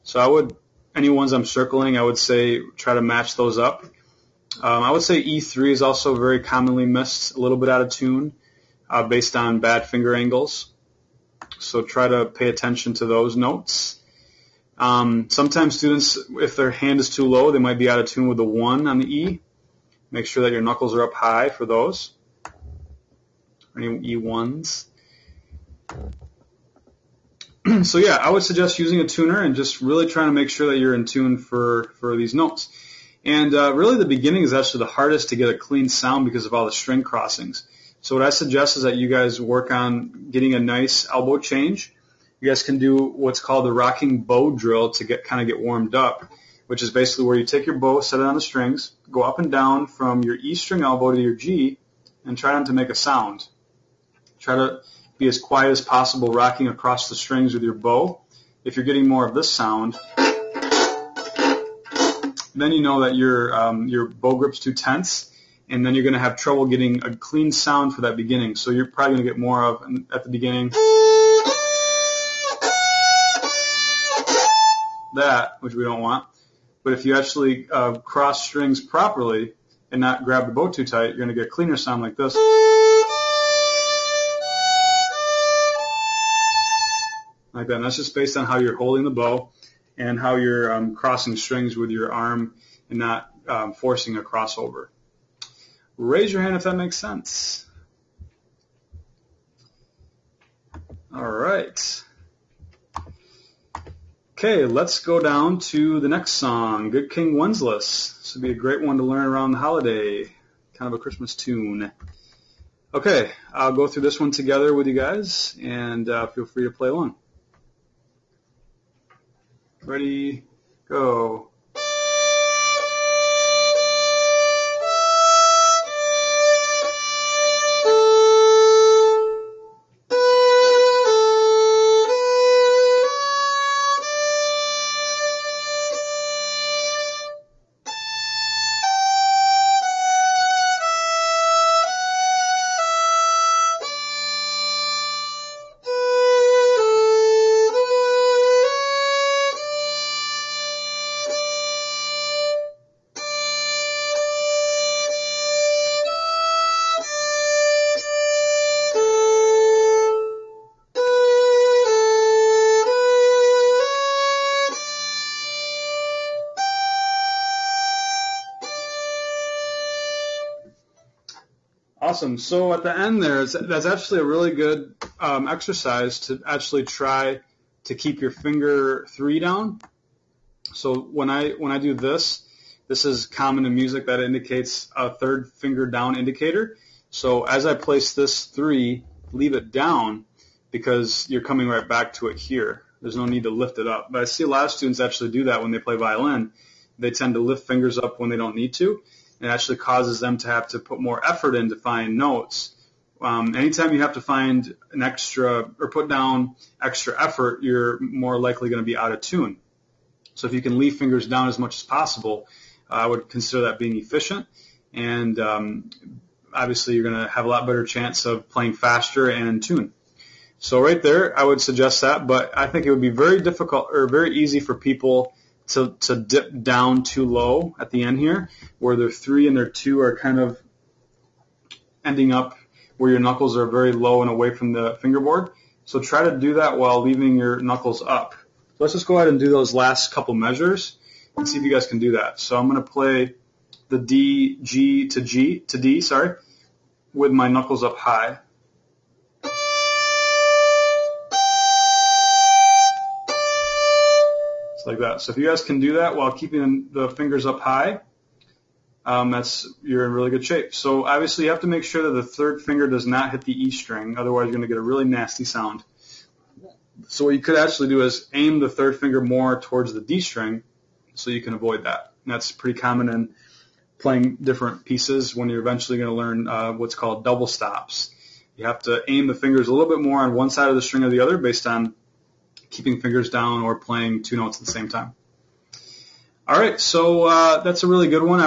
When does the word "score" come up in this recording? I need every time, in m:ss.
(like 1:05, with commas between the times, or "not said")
not said.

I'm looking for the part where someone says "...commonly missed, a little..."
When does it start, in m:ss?
0:06.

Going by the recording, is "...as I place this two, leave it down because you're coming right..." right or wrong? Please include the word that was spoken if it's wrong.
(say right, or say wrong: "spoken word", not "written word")
wrong: "three", not "two".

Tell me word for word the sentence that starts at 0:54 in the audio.
Try to be as quiet as possible, rocking across the strings with your bow.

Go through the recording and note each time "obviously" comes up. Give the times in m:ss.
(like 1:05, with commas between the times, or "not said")
3:36, 4:21.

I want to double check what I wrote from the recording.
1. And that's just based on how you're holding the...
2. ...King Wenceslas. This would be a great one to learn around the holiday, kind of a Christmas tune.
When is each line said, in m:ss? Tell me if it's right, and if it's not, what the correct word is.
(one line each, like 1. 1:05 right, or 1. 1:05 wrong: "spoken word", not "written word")
1. 1:27 right
2. 1:47 right.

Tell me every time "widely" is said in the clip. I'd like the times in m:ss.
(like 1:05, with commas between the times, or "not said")
not said.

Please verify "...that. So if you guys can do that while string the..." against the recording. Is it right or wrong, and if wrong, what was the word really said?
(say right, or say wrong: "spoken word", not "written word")
wrong: "keeping", not "string".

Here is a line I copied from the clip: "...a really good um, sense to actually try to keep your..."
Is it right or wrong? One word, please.
wrong.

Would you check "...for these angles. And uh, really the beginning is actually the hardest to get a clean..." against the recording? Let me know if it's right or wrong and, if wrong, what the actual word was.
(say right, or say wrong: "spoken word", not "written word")
wrong: "notes", not "angles".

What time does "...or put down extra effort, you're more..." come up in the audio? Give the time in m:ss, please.
3:25.